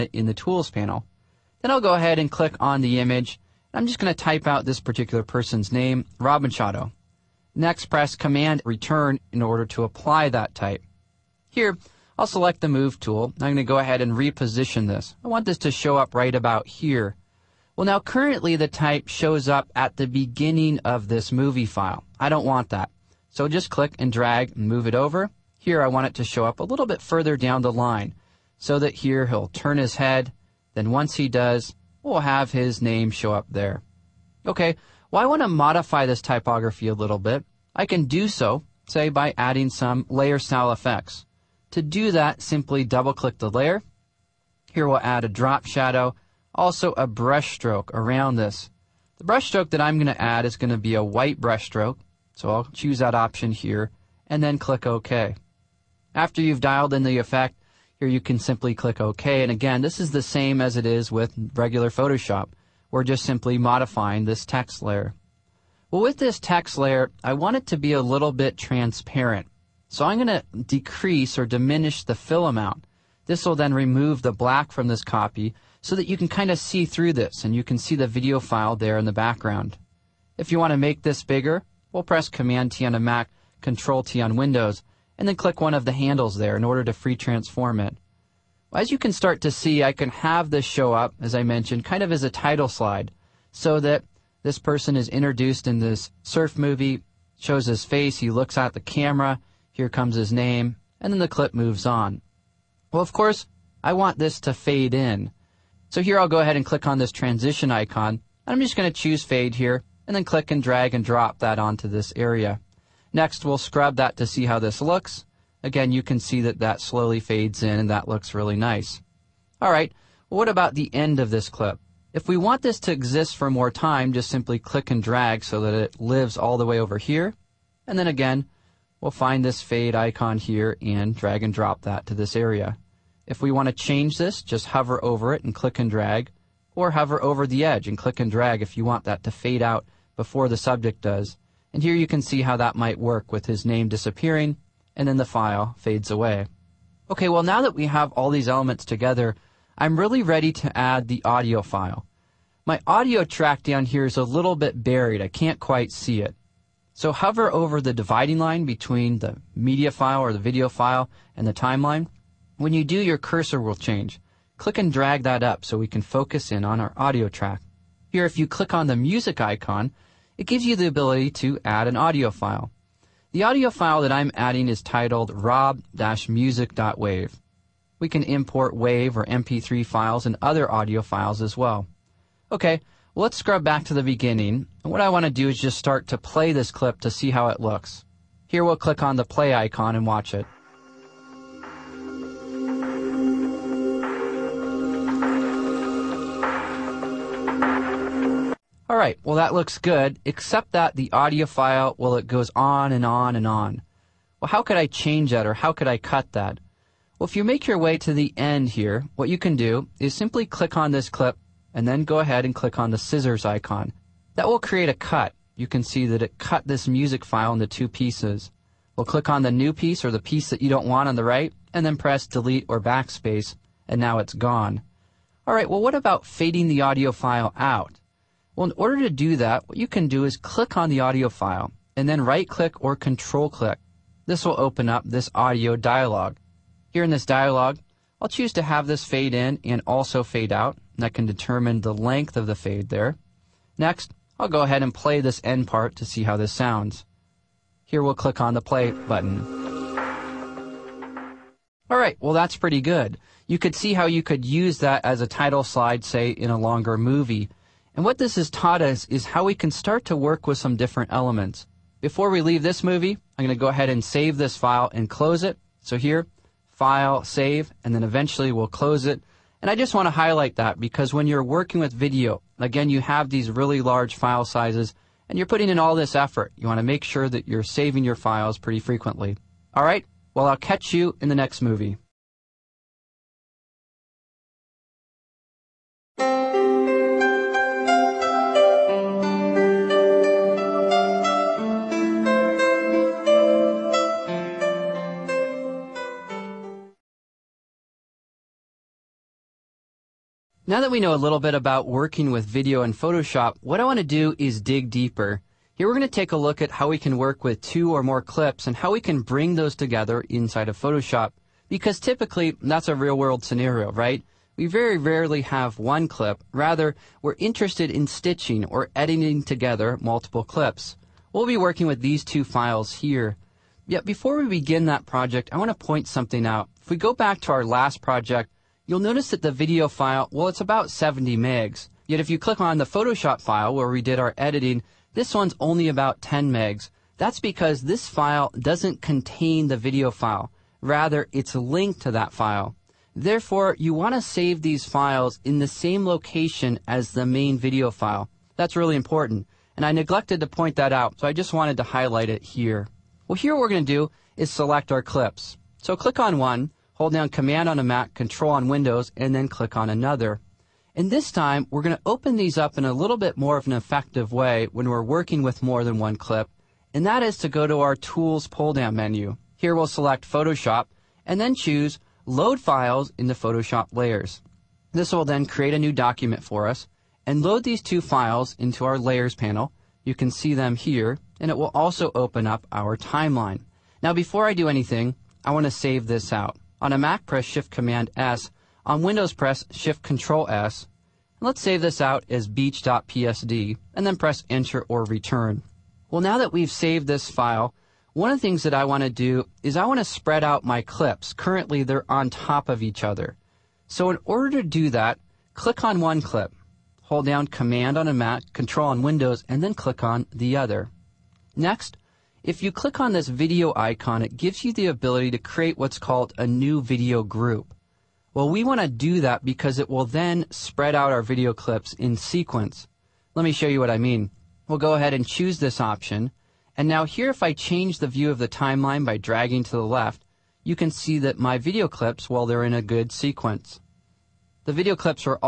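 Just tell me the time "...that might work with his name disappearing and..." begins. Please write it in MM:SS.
02:22.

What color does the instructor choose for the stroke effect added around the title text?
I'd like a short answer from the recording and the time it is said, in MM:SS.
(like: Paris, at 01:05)
White, at 00:51.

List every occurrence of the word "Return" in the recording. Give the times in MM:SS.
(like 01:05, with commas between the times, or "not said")
00:08, 06:35.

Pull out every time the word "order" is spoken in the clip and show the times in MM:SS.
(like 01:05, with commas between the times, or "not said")
00:09, 01:26, 03:48, 06:44.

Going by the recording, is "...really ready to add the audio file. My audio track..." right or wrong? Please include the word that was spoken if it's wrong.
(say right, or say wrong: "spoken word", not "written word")
right.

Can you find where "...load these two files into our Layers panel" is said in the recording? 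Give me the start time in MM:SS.
06:17.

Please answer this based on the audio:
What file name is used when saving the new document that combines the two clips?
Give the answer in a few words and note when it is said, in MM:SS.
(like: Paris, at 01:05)
beach.psd, at 06:32.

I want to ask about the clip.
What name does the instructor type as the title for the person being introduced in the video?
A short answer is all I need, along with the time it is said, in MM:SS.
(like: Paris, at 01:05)
Robin Machado, at 00:06.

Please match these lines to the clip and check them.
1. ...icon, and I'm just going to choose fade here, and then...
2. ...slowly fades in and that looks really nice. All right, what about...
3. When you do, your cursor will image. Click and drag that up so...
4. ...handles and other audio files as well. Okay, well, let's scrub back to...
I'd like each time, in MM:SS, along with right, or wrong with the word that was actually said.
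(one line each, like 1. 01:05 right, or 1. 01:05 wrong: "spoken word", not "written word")
1. 01:47 right
2. 01:56 right
3. 02:42 wrong: "change", not "image"
4. 02:59 wrong: "files", not "handles".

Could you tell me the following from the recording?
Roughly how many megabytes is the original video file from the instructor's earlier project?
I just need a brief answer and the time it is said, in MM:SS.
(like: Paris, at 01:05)
70, at 05:30.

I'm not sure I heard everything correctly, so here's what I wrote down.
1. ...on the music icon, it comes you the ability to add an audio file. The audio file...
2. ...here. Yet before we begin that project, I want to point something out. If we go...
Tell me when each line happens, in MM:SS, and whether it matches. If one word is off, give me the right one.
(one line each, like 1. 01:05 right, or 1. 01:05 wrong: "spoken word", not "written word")
1. 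02:48 wrong: "gives", not "comes"
2. 05:22 right.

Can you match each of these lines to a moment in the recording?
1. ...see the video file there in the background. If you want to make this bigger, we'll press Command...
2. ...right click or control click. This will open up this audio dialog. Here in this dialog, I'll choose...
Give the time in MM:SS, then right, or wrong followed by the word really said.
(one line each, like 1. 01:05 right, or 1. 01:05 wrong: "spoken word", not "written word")
1. 01:17 right
2. 03:52 right.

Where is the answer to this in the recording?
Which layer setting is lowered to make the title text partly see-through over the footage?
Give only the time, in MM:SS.
01:12.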